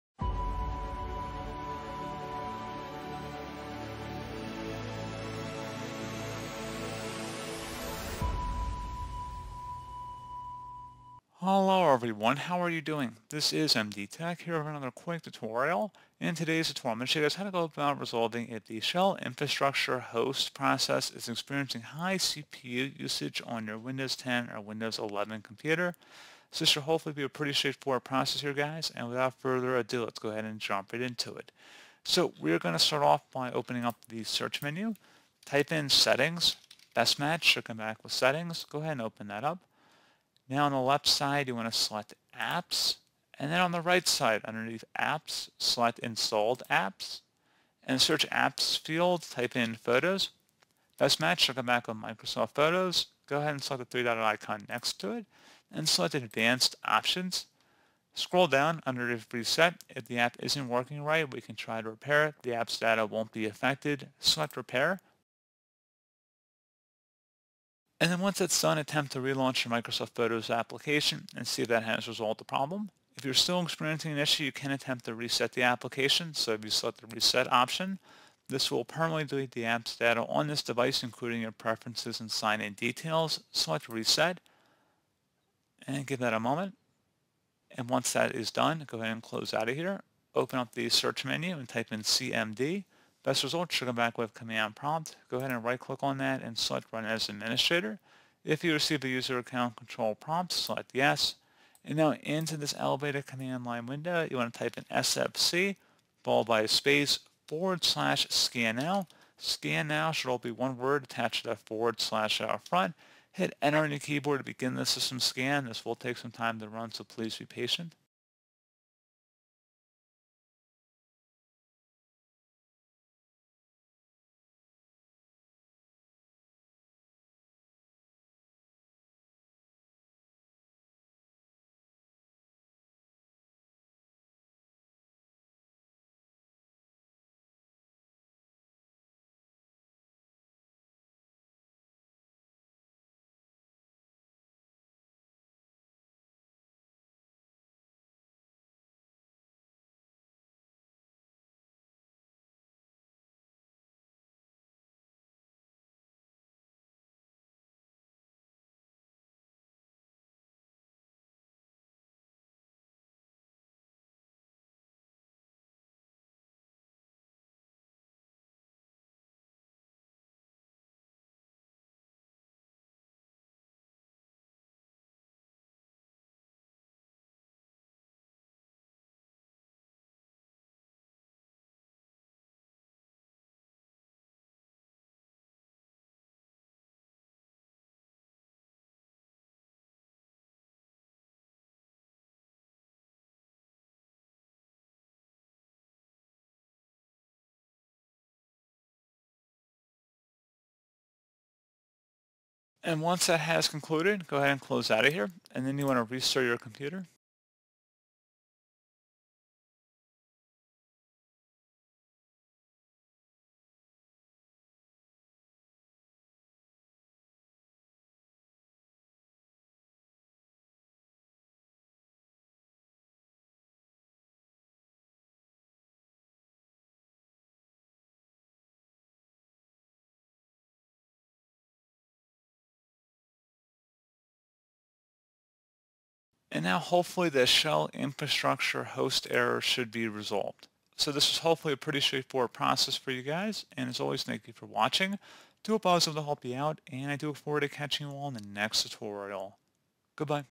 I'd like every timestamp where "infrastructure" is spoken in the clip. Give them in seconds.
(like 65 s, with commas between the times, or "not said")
19 s, 237 s.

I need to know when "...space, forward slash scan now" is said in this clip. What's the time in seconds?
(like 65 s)
106 s.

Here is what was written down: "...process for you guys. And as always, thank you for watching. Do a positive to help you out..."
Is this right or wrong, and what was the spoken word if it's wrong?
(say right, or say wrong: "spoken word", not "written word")
right.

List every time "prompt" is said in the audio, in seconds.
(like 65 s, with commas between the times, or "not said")
94 s, 100 s.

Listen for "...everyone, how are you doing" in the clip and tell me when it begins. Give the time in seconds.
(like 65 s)
11 s.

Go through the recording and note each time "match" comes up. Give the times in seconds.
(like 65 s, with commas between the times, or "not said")
37 s, 51 s.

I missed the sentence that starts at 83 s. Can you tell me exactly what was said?
Select reset and give that a moment.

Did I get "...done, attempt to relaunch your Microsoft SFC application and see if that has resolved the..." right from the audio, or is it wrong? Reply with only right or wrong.
wrong.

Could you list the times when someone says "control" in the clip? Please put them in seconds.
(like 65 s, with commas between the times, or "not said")
99 s.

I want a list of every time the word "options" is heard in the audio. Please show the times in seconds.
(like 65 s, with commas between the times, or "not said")
56 s, 77 s.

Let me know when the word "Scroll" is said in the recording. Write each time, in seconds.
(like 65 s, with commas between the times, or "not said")
58 s.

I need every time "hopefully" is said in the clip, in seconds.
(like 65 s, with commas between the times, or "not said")
26 s, 236 s, 241 s.